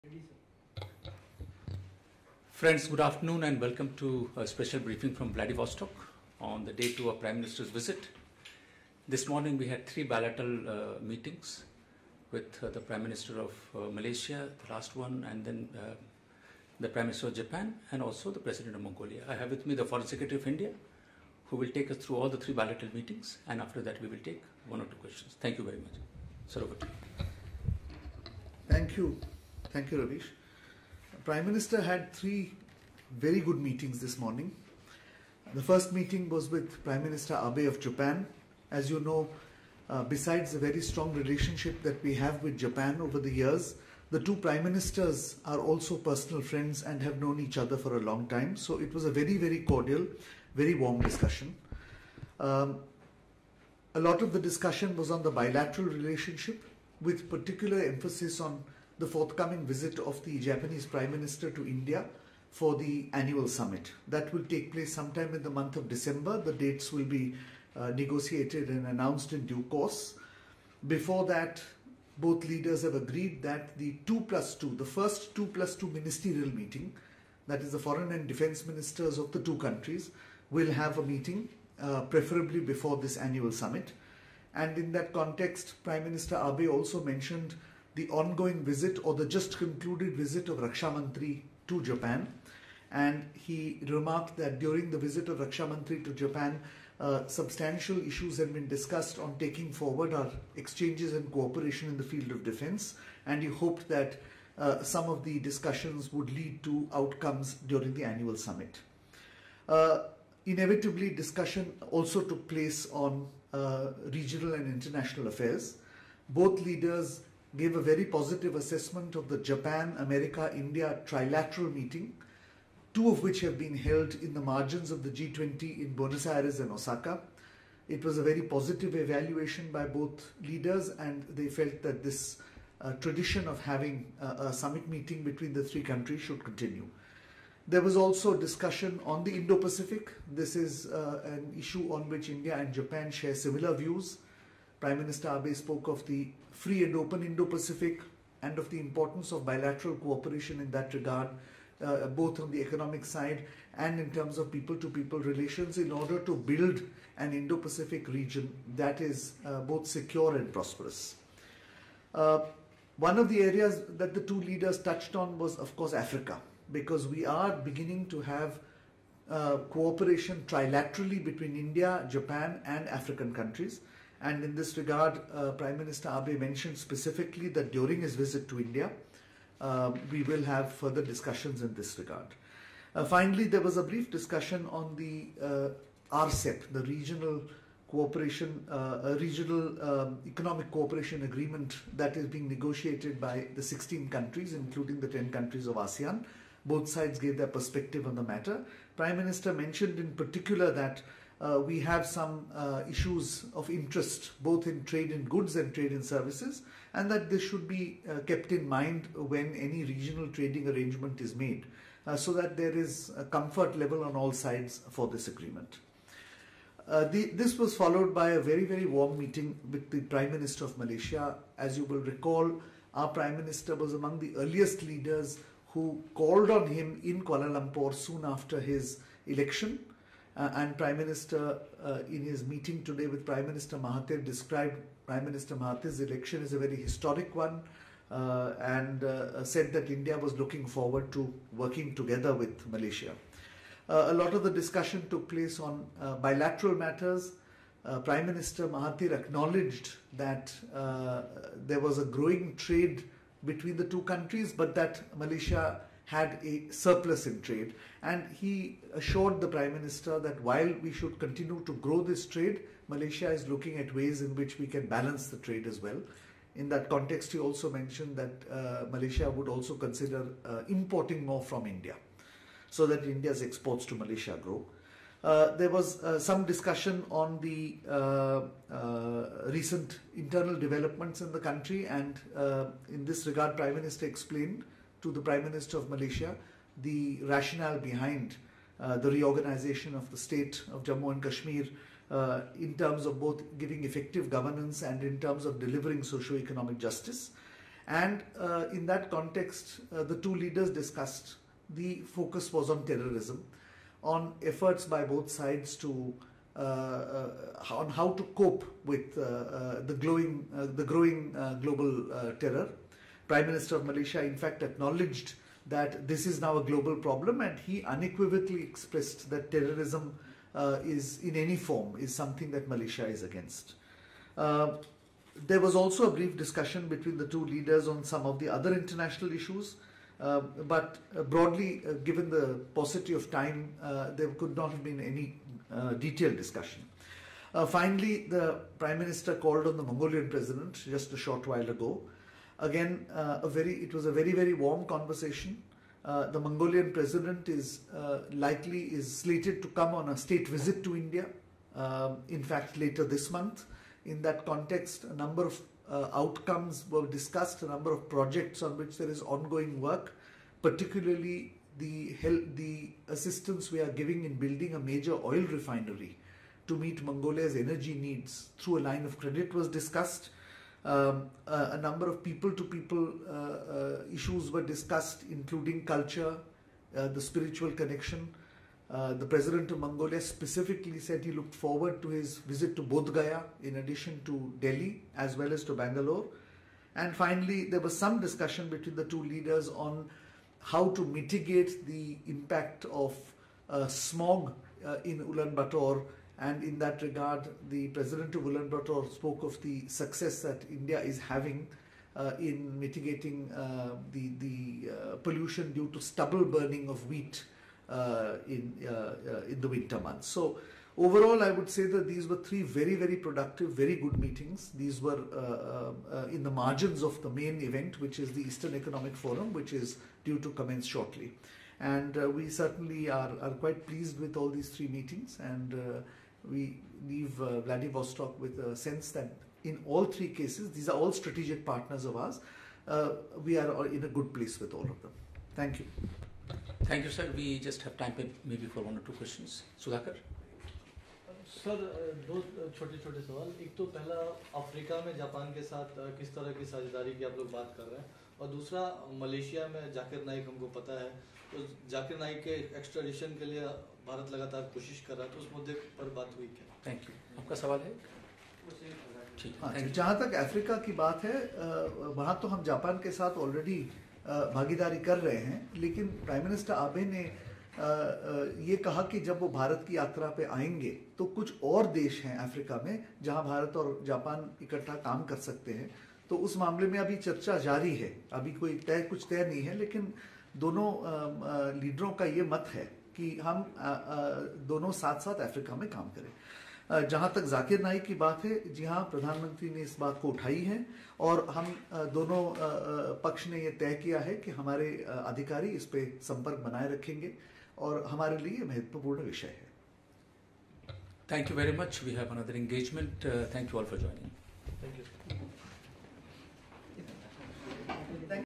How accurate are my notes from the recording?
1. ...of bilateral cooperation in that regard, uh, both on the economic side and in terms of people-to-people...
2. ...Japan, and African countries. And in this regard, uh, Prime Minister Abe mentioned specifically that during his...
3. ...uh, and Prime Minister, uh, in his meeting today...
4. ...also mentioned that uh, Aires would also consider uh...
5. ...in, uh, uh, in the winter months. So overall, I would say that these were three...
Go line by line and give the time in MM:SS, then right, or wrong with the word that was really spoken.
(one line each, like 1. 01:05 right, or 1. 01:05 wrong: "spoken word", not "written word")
1. 02:29 right
2. 02:52 right
3. 03:50 right
4. 04:27 wrong: "Malaysia", not "Aires"
5. 06:48 right.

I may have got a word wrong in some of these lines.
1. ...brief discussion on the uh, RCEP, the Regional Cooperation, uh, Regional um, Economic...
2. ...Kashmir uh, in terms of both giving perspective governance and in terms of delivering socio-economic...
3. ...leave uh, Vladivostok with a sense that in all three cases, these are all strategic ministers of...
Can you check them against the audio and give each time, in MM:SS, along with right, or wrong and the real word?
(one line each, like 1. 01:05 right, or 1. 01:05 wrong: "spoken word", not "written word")
1. 03:03 right
2. 04:51 wrong: "effective", not "perspective"
3. 07:07 wrong: "partners", not "ministers".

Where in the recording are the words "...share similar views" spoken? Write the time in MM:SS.
02:23.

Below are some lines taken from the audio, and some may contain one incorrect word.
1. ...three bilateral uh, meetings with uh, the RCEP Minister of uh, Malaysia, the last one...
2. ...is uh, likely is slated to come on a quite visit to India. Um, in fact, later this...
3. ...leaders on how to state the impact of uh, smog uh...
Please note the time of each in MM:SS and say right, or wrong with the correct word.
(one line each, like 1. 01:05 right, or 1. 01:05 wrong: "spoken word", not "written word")
1. 00:09 wrong: "Prime", not "RCEP"
2. 05:47 wrong: "state", not "quite"
3. 06:29 wrong: "mitigate", not "state".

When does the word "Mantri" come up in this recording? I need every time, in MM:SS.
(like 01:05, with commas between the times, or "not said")
01:30, 01:35.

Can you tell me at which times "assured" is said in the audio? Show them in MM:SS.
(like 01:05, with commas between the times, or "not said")
04:18.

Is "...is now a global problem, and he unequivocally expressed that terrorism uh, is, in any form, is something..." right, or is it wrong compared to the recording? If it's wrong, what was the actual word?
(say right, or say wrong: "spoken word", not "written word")
right.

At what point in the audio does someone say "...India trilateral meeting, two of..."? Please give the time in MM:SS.
02:00.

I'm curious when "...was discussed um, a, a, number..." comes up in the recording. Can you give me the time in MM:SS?
06:09.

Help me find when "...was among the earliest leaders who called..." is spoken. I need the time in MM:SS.
03:43.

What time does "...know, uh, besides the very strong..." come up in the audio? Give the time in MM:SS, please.
00:38.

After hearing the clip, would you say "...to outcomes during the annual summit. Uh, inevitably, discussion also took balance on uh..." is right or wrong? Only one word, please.
wrong.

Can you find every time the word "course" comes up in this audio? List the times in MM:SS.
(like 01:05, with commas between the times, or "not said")
01:09, 02:45.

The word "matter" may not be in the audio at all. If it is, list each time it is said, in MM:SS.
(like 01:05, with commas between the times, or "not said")
03:18, 04:06.